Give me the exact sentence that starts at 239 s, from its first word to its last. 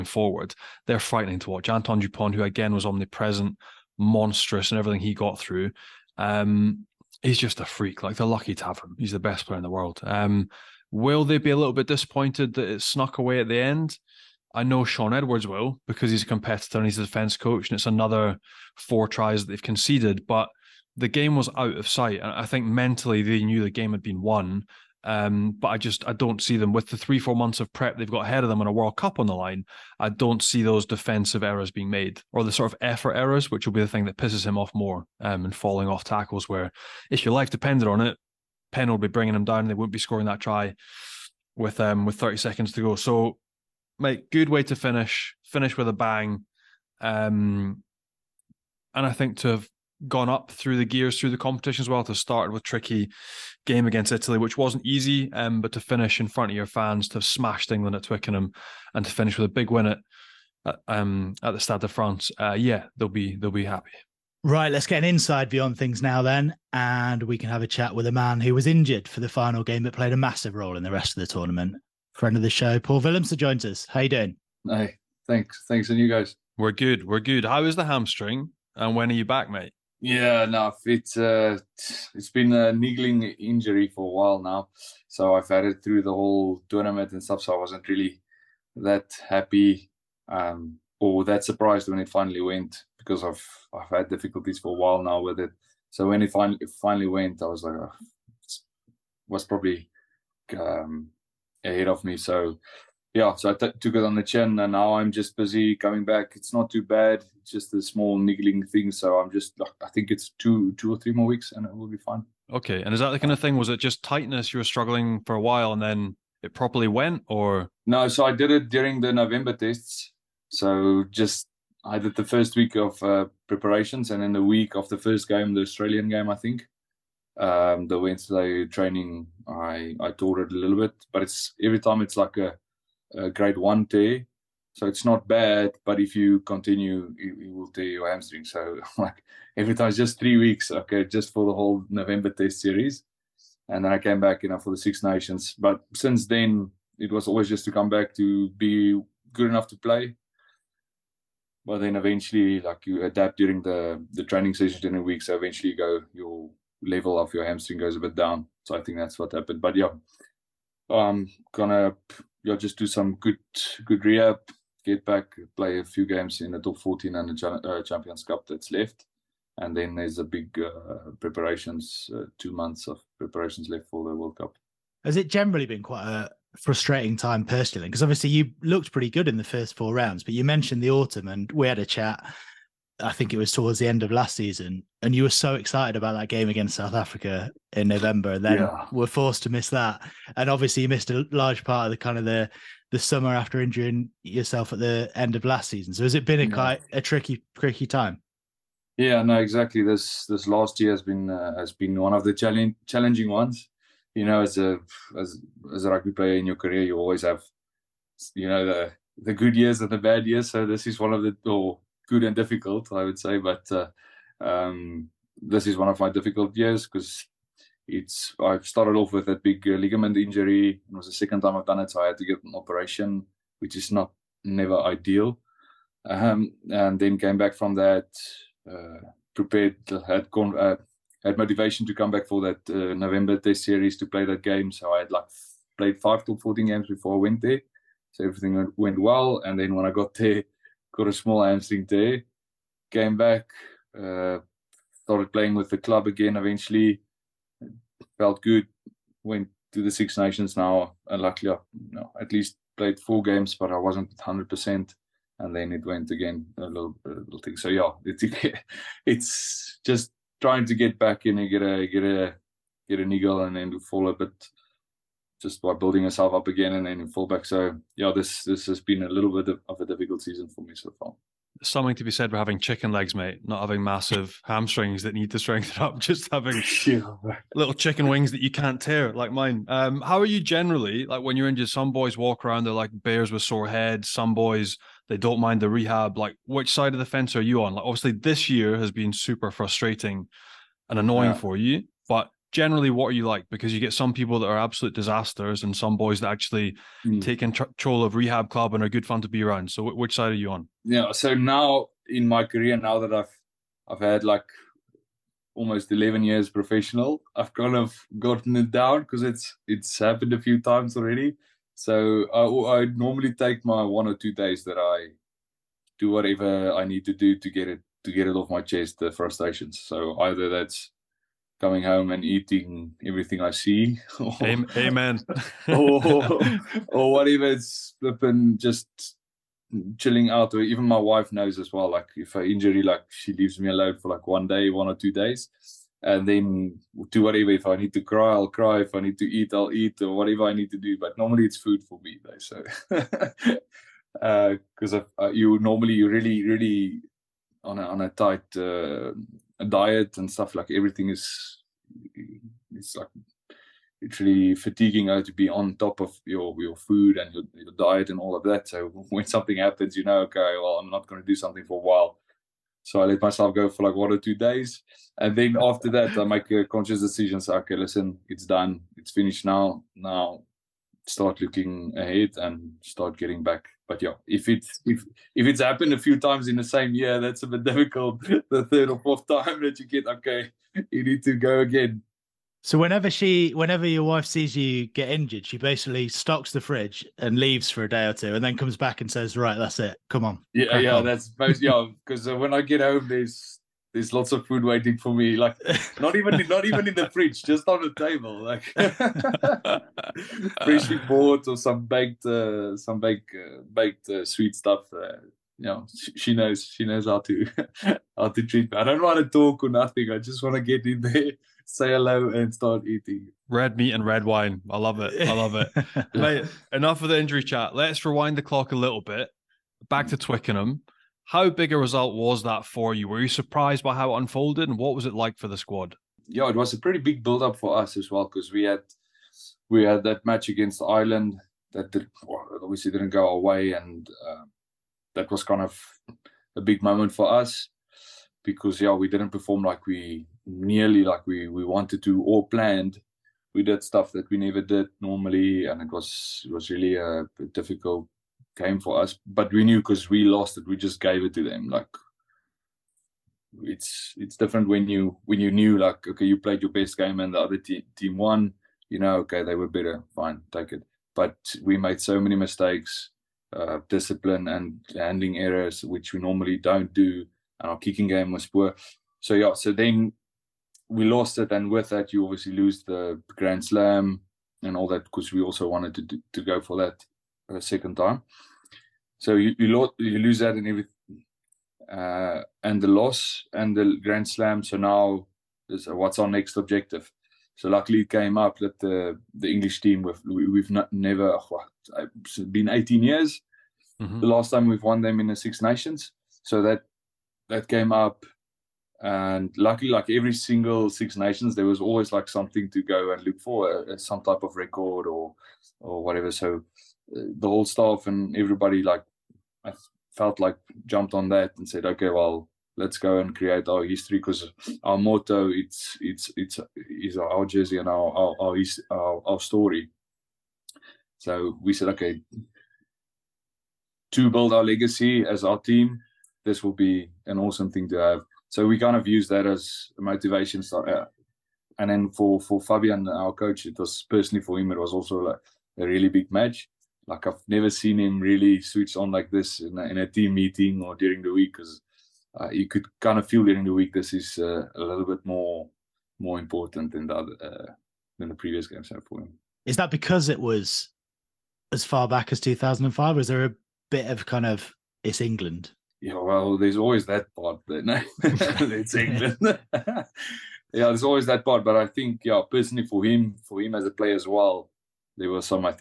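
And then when I got there, got a small hamstring tear.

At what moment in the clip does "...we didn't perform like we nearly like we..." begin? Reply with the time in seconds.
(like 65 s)
438 s.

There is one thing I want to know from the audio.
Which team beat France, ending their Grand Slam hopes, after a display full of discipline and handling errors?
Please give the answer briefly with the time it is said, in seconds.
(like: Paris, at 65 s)
Ireland, at 430 s.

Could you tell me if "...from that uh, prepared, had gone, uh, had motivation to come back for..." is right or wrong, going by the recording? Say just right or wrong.
right.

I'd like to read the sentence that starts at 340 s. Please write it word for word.
But normally it's food for me though.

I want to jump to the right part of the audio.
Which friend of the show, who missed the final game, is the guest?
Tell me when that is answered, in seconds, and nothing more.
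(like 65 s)
72 s.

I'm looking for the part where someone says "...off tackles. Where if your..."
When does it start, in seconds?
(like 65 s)
35 s.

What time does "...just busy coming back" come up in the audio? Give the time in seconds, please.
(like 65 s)
105 s.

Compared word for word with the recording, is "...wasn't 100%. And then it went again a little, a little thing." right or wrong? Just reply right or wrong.
right.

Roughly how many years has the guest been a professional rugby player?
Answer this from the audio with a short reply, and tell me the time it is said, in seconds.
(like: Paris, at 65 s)
11, at 305 s.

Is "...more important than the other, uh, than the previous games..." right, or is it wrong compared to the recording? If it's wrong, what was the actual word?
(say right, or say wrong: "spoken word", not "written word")
right.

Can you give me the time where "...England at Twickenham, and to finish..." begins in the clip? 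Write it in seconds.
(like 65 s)
57 s.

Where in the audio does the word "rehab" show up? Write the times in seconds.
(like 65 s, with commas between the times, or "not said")
164 s, 285 s, 298 s.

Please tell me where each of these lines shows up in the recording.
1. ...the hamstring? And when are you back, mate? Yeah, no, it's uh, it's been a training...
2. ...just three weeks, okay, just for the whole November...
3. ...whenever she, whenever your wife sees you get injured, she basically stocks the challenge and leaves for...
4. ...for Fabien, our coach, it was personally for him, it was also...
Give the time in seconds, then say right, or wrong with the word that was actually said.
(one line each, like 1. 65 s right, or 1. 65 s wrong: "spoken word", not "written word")
1. 77 s wrong: "niggling", not "training"
2. 139 s right
3. 382 s wrong: "fridge", not "challenge"
4. 532 s right.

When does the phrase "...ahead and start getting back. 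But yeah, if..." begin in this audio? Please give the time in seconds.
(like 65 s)
371 s.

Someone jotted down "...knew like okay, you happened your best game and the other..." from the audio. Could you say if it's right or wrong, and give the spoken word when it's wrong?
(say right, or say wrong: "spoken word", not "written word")
wrong: "played", not "happened".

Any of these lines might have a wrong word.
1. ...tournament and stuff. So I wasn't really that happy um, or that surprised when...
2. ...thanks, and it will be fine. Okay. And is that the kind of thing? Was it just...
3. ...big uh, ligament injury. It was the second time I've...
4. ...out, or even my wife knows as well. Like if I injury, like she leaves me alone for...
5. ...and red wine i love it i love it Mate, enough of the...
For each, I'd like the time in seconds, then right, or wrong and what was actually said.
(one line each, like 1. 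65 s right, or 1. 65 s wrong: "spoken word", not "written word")
1. 86 s right
2. 111 s wrong: "weeks", not "thanks"
3. 219 s right
4. 330 s right
5. 413 s right.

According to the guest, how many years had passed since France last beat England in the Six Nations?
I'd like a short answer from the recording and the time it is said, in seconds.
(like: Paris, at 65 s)
18 years, at 492 s.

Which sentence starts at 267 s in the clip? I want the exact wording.
So yeah, this this has been a little bit of a difficult season for me so far.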